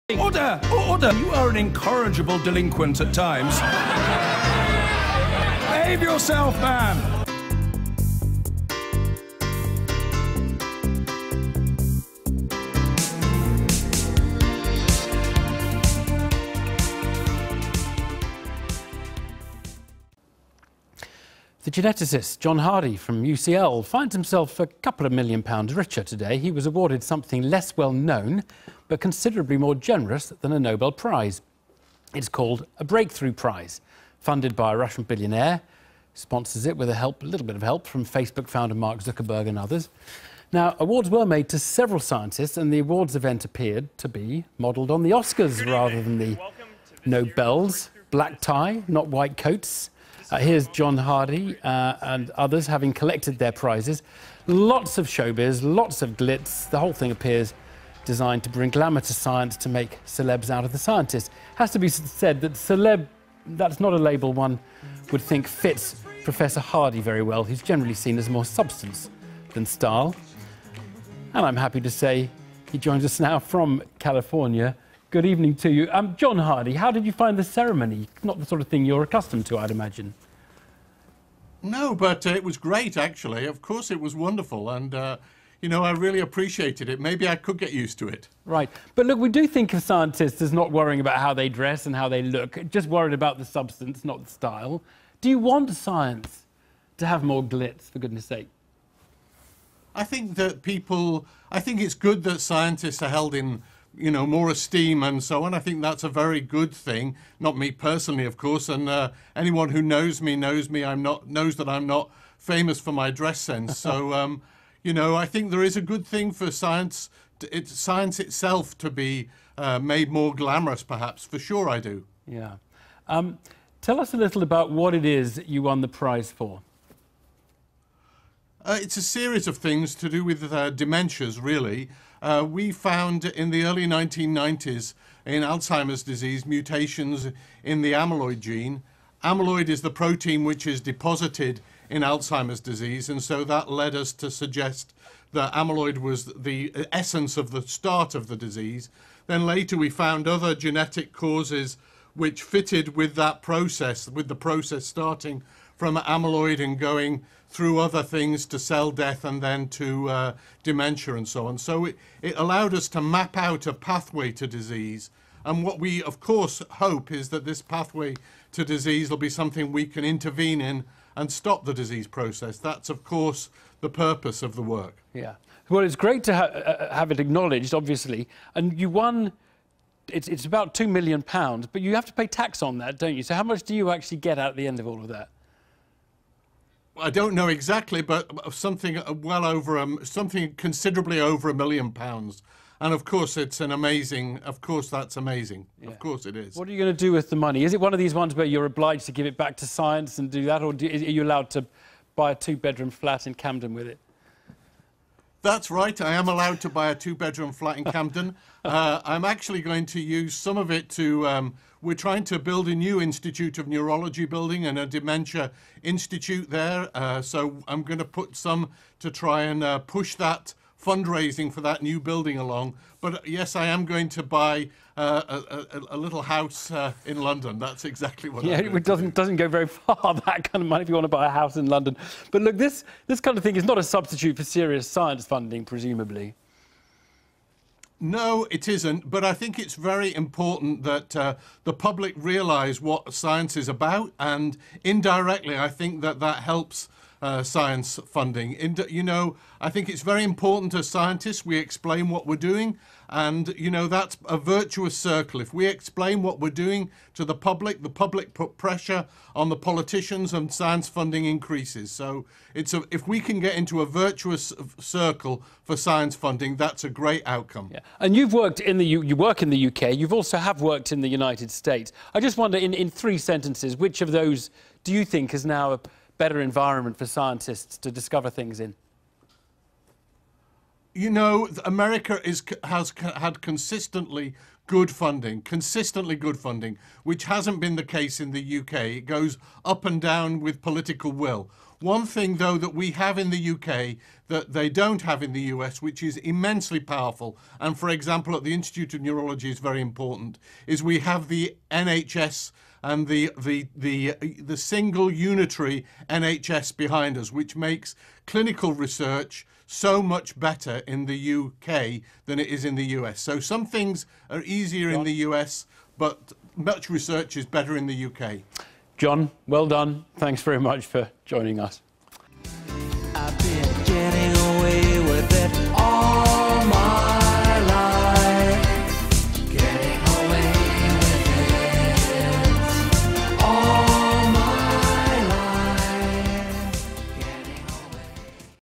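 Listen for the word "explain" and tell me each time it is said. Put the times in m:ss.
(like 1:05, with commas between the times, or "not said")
4:11, 4:15.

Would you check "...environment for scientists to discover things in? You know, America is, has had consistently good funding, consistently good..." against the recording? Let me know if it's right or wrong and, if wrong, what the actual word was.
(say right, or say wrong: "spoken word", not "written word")
right.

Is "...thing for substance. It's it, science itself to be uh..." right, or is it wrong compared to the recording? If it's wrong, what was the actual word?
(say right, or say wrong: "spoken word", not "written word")
wrong: "science", not "substance".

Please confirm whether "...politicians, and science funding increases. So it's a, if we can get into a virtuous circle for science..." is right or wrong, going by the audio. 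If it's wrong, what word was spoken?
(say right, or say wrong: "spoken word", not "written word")
right.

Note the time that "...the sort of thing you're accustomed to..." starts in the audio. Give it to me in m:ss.
1:18.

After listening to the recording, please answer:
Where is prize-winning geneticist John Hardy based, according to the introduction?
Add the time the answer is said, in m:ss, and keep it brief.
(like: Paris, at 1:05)
UCL, at 0:23.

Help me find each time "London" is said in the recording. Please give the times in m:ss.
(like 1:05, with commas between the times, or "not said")
3:47, 3:51.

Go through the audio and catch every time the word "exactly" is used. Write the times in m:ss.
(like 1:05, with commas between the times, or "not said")
3:07, 3:47.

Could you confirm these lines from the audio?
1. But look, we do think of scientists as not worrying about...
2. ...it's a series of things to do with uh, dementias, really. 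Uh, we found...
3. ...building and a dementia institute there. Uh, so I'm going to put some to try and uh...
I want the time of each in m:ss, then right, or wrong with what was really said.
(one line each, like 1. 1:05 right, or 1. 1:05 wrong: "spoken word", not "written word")
1. 1:28 right
2. 2:08 right
3. 3:34 right.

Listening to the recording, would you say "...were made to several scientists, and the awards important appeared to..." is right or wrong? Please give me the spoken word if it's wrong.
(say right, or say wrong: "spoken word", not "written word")
wrong: "event", not "important".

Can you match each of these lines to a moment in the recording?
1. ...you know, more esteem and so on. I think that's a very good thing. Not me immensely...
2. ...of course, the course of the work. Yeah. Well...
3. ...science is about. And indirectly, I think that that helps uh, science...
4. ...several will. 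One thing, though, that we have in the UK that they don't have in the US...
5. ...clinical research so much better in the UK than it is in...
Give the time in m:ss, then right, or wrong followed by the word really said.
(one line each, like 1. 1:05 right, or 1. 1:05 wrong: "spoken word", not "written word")
1. 1:43 wrong: "personally", not "immensely"
2. 2:52 wrong: "purpose", not "course"
3. 4:03 right
4. 4:50 wrong: "political", not "several"
5. 5:08 right.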